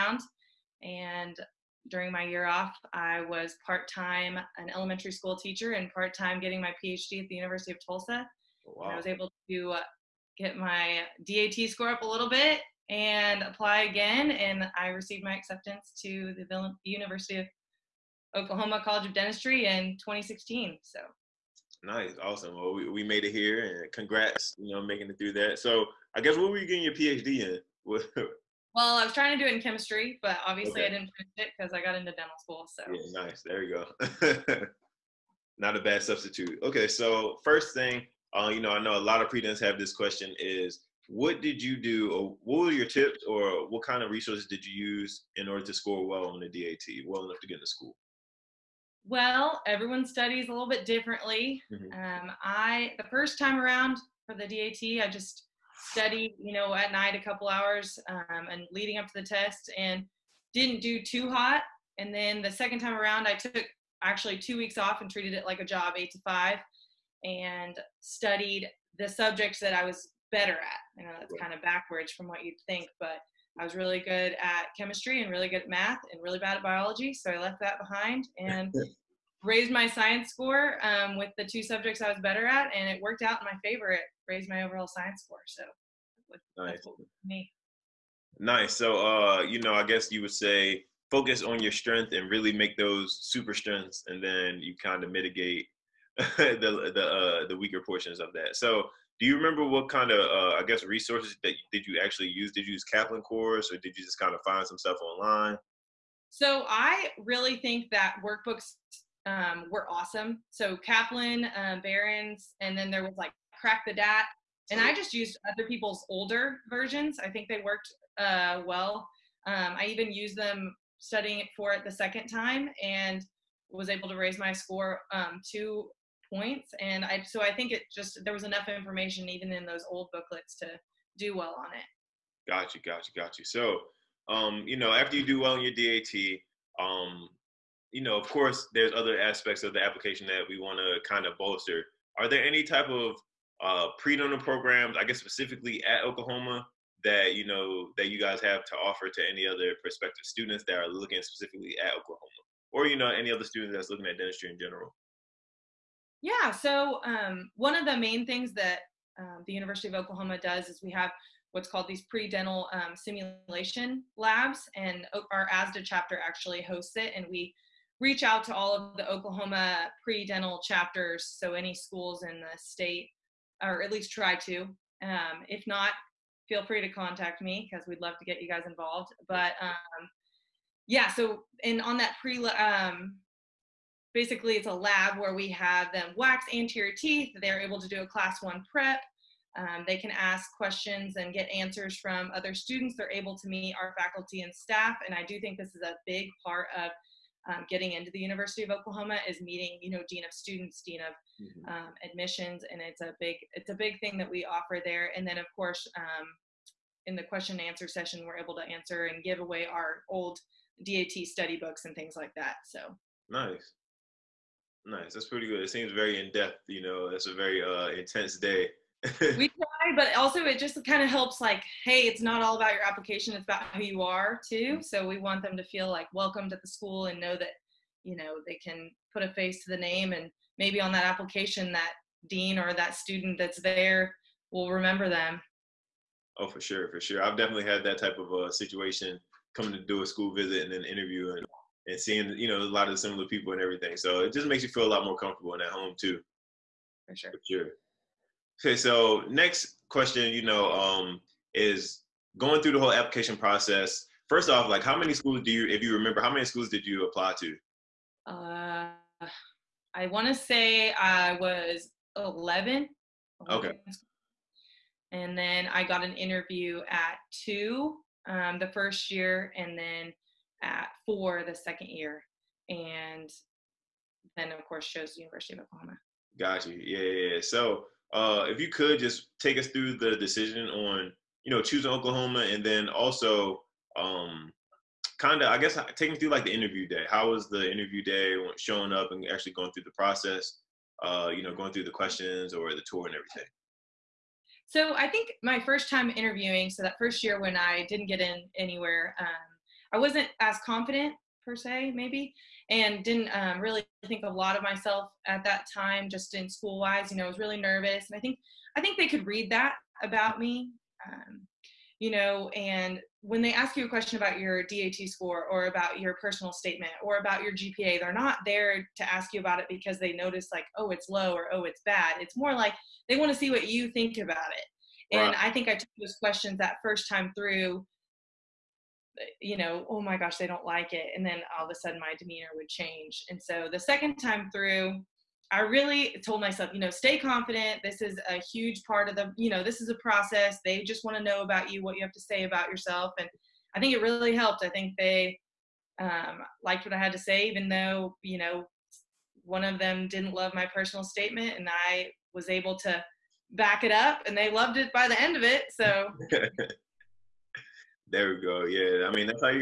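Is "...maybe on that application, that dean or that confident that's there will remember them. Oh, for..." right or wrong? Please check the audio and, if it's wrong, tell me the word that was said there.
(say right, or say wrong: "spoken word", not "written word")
wrong: "student", not "confident".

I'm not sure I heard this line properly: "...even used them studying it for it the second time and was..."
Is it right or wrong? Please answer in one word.
right.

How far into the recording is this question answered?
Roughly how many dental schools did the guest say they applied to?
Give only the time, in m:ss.
4:22.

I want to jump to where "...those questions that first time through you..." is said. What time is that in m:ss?
5:25.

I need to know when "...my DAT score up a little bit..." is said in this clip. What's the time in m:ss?
0:10.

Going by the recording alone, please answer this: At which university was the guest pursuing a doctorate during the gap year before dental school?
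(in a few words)
University of Tulsa.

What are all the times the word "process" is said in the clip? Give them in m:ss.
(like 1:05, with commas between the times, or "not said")
4:13, 4:49, 5:39.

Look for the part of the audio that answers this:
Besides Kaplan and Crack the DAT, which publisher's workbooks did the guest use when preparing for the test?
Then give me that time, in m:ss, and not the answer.
1:51.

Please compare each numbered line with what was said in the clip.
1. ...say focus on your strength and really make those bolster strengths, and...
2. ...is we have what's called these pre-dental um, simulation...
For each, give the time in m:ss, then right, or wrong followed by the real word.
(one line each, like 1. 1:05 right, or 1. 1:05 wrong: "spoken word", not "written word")
1. 1:30 wrong: "super", not "bolster"
2. 2:40 right.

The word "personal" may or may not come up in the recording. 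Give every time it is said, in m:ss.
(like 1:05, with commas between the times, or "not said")
5:16, 5:50.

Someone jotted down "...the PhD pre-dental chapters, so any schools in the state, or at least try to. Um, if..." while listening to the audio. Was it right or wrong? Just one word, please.
wrong.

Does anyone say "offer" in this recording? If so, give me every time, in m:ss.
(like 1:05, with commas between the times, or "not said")
2:28, 3:24.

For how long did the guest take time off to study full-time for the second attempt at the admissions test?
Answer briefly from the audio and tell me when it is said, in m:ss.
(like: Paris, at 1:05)
two weeks, at 1:04.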